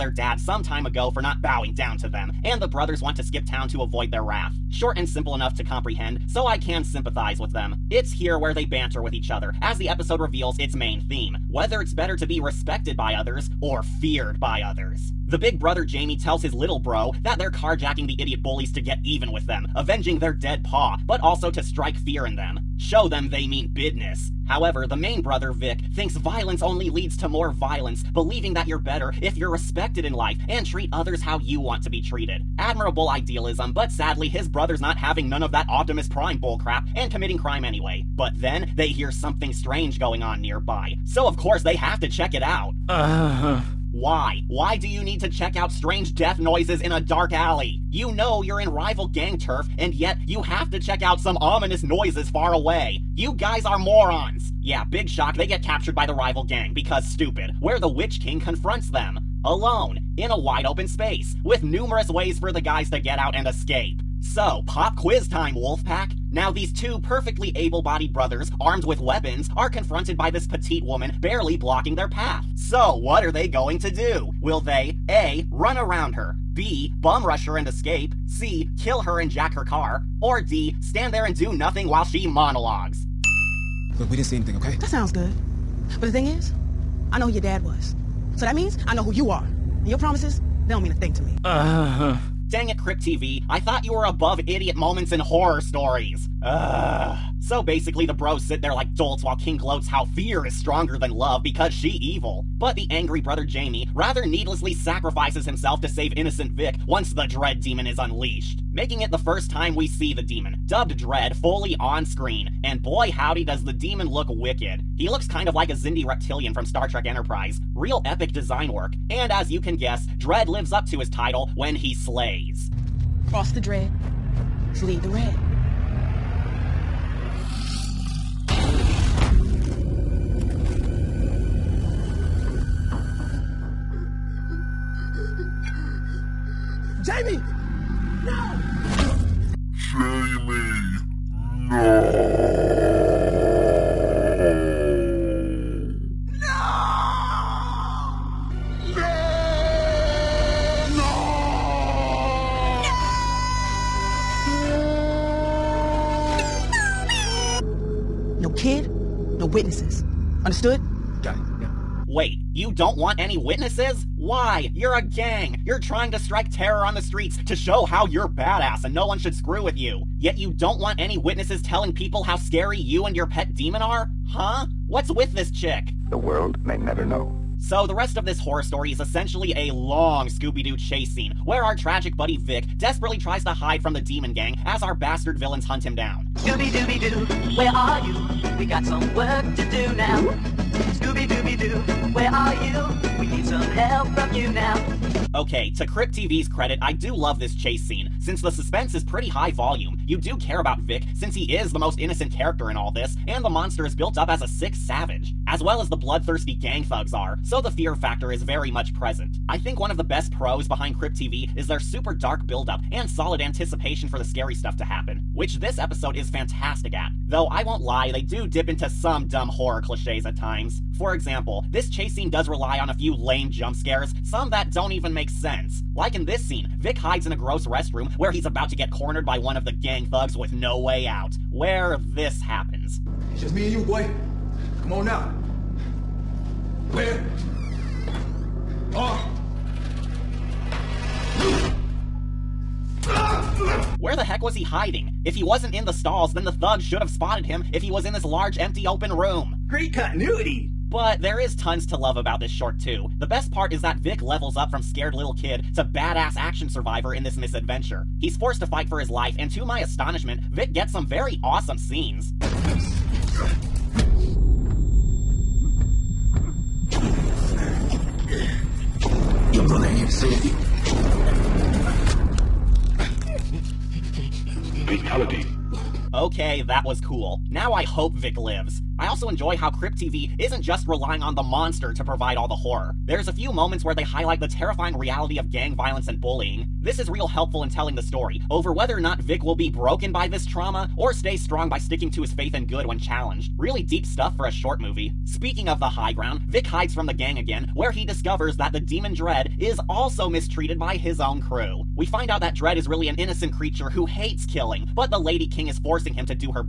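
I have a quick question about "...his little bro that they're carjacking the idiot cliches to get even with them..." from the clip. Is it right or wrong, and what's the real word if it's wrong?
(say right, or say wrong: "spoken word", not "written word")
wrong: "bullies", not "cliches".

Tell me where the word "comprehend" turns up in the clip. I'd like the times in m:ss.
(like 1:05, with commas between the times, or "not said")
0:05.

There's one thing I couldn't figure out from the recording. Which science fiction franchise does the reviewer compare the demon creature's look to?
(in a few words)
Star Trek Enterprise.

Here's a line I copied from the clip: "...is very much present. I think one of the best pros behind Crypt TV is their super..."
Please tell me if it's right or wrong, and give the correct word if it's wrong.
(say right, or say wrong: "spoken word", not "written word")
right.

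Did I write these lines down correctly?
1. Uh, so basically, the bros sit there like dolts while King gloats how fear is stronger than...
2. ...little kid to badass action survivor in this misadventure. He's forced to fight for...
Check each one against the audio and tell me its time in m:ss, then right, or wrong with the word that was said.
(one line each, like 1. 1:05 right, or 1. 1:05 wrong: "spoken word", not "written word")
1. 1:36 right
2. 4:15 right.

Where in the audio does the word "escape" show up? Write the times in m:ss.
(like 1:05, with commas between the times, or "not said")
1:03, 1:17.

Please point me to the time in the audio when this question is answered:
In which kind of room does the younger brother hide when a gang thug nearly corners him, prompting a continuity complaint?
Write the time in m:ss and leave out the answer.
3:47.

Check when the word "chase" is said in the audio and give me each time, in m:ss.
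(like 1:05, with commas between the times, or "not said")
3:00, 3:17, 3:41.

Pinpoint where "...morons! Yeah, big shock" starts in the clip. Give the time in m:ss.
0:53.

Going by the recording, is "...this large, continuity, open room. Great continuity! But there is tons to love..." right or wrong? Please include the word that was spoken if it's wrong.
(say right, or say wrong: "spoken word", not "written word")
wrong: "empty", not "continuity".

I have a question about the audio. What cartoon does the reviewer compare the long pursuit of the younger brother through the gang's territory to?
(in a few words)
Scooby-Doo.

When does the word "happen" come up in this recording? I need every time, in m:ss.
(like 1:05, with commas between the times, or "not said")
3:34, 3:52.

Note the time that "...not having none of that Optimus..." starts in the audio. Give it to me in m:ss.
0:34.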